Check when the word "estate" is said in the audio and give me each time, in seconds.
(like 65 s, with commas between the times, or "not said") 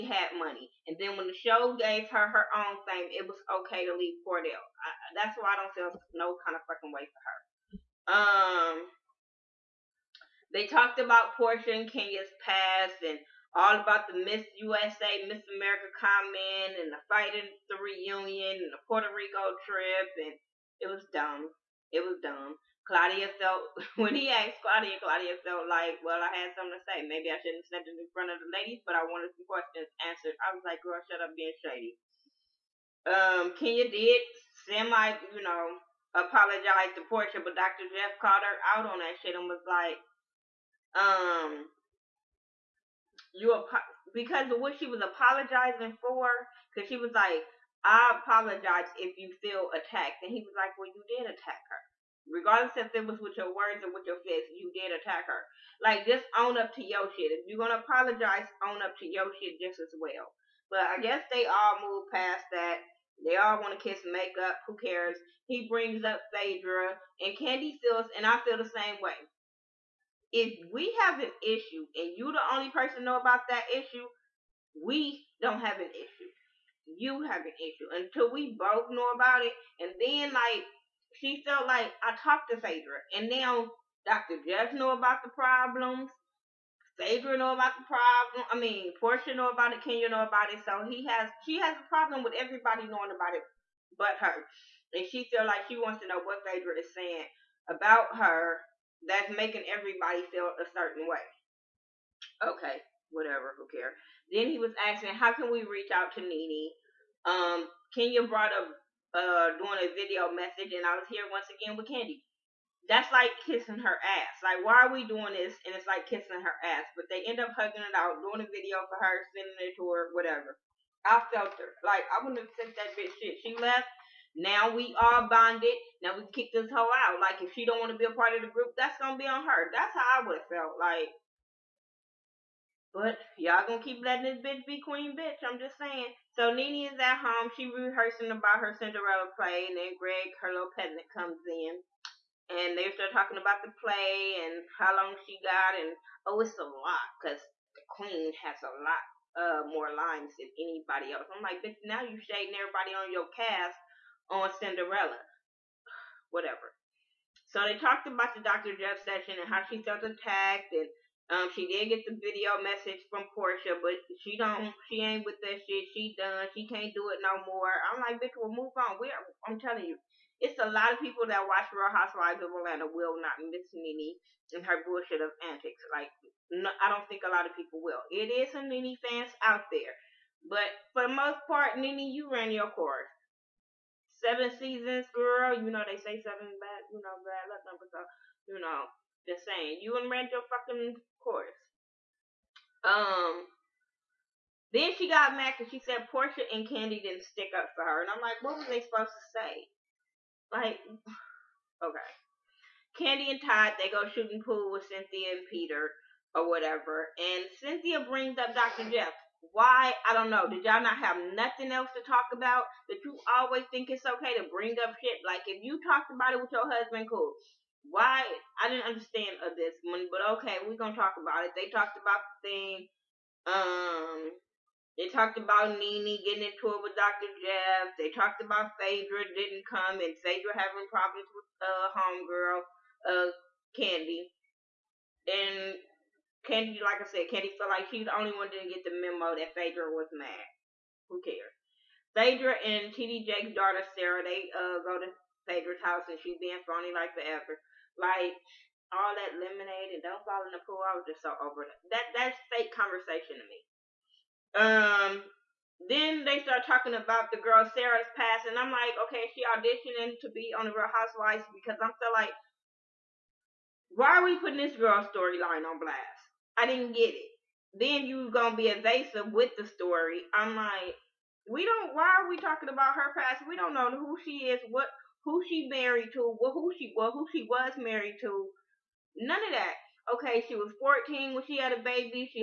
not said.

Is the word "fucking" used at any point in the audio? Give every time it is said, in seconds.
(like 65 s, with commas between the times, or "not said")
6 s, 190 s.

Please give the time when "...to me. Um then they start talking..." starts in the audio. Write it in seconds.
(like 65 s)
253 s.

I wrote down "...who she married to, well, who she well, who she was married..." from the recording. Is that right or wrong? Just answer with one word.
right.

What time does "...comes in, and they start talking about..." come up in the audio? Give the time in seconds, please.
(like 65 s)
141 s.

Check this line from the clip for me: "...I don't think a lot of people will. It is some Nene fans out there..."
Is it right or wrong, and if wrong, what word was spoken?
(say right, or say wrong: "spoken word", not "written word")
right.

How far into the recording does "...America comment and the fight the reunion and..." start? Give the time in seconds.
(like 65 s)
15 s.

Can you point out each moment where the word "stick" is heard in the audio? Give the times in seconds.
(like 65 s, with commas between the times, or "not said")
197 s.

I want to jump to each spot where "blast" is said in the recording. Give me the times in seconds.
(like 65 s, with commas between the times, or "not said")
265 s.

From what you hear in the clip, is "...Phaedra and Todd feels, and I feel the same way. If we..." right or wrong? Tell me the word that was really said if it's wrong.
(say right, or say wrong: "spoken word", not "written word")
wrong: "Kandi", not "Todd".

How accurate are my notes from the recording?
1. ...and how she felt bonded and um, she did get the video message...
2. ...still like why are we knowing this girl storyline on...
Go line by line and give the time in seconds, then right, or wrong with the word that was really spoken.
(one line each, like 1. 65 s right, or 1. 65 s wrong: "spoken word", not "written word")
1. 159 s wrong: "attacked", not "bonded"
2. 261 s wrong: "putting", not "knowing".